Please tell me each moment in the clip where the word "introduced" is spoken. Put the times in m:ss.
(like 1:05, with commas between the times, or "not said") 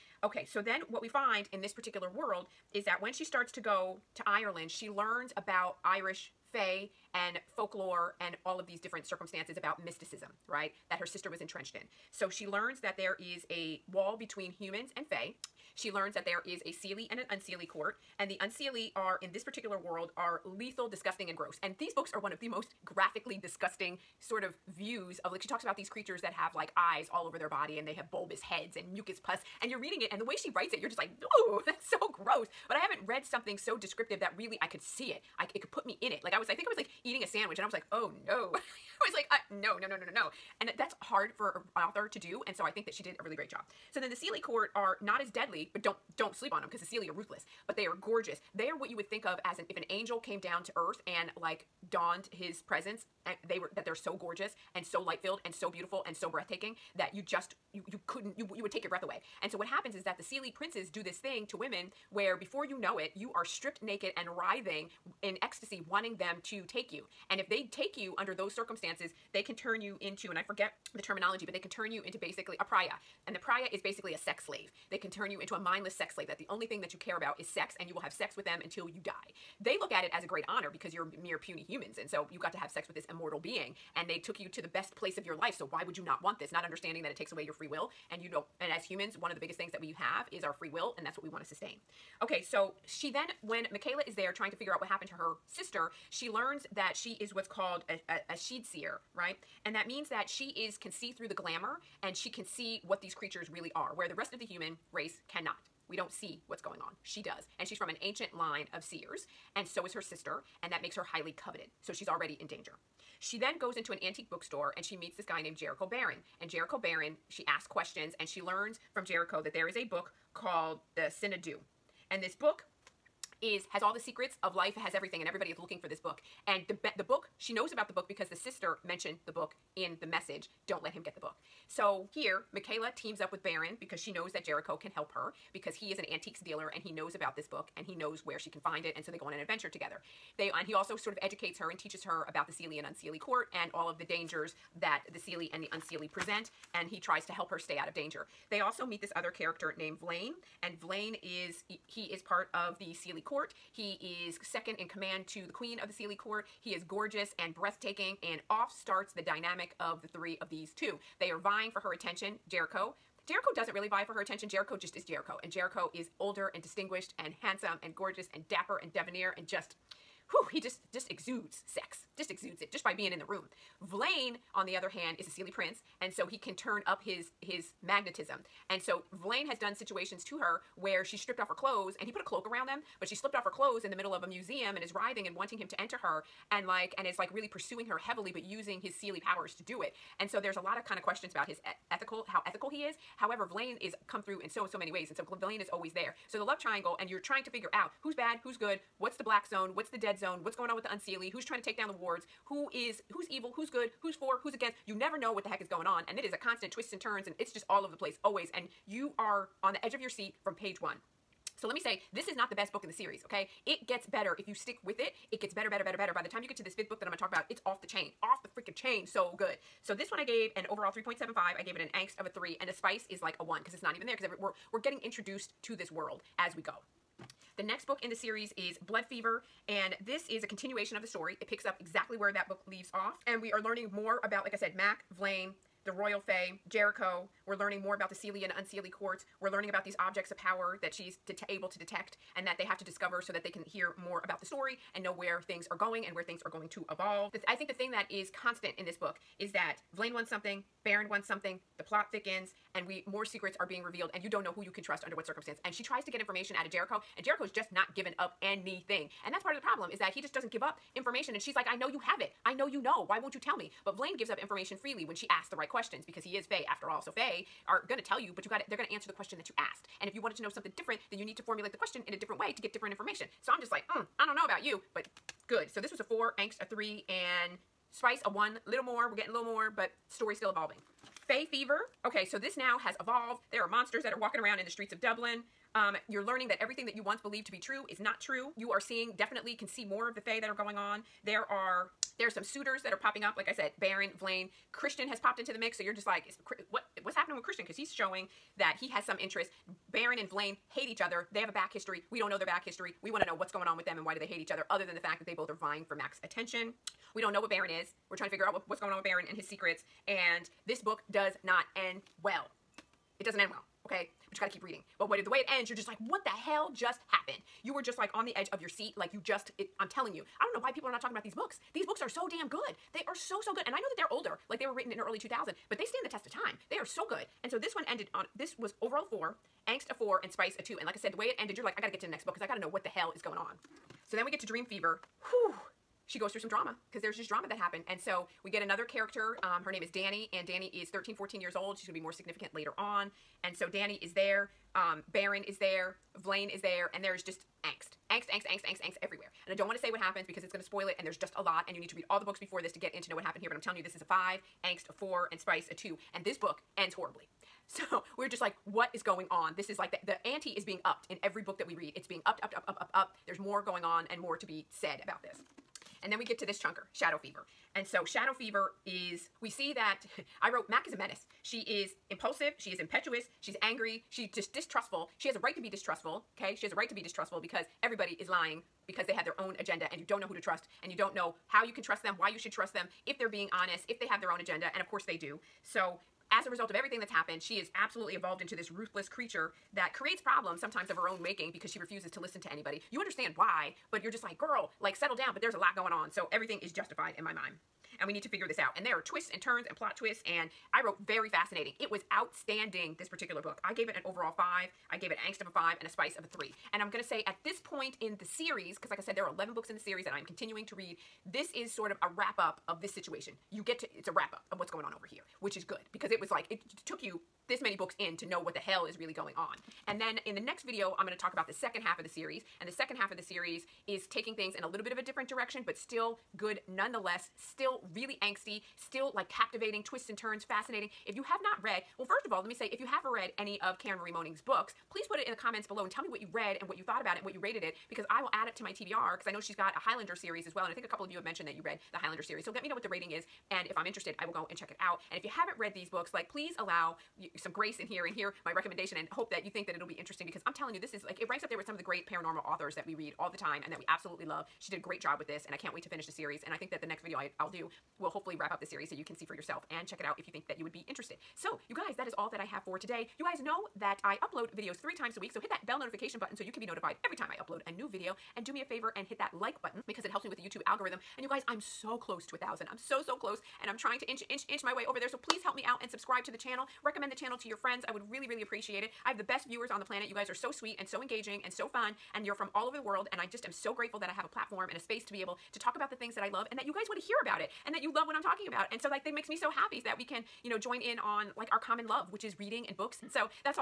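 3:45.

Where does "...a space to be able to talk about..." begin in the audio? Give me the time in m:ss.
8:04.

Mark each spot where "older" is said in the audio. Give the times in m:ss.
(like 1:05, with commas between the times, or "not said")
2:46, 5:24.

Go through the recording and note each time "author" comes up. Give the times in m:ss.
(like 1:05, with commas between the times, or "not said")
0:41, 7:32.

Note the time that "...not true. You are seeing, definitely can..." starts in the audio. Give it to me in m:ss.
4:47.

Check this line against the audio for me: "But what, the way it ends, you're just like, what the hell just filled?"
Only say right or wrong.
wrong.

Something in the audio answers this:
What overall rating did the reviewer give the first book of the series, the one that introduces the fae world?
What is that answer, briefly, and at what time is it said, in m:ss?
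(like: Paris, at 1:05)
3.75, at 3:40.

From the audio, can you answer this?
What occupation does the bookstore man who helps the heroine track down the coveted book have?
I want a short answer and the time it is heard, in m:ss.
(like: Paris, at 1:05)
antiques dealer, at 2:16.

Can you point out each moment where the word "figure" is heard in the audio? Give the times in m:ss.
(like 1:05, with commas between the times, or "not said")
1:34, 3:17, 5:08, 6:38.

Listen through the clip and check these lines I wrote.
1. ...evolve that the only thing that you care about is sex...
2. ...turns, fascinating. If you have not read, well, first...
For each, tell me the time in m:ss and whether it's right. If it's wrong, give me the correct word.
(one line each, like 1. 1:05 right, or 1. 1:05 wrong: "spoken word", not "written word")
1. 1:16 wrong: "slave", not "evolve"
2. 7:10 right.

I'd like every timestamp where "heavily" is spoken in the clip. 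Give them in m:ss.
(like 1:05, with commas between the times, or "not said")
3:07.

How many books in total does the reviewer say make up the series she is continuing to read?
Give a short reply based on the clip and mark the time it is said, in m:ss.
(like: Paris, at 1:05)
11, at 6:49.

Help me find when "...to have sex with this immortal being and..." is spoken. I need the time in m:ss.
1:22.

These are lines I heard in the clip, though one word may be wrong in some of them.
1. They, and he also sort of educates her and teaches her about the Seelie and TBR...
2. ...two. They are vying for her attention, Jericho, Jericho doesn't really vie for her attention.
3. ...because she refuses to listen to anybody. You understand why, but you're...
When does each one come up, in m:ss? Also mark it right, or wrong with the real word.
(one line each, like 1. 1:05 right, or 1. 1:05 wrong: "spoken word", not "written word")
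1. 2:20 wrong: "Unseelie", not "TBR"
2. 2:40 right
3. 6:31 right.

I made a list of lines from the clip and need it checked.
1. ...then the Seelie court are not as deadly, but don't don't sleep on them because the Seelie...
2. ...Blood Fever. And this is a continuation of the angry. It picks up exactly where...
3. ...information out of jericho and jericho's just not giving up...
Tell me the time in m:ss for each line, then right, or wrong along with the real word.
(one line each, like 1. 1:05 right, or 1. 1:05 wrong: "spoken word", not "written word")
1. 0:43 right
2. 3:48 wrong: "story", not "angry"
3. 4:16 right.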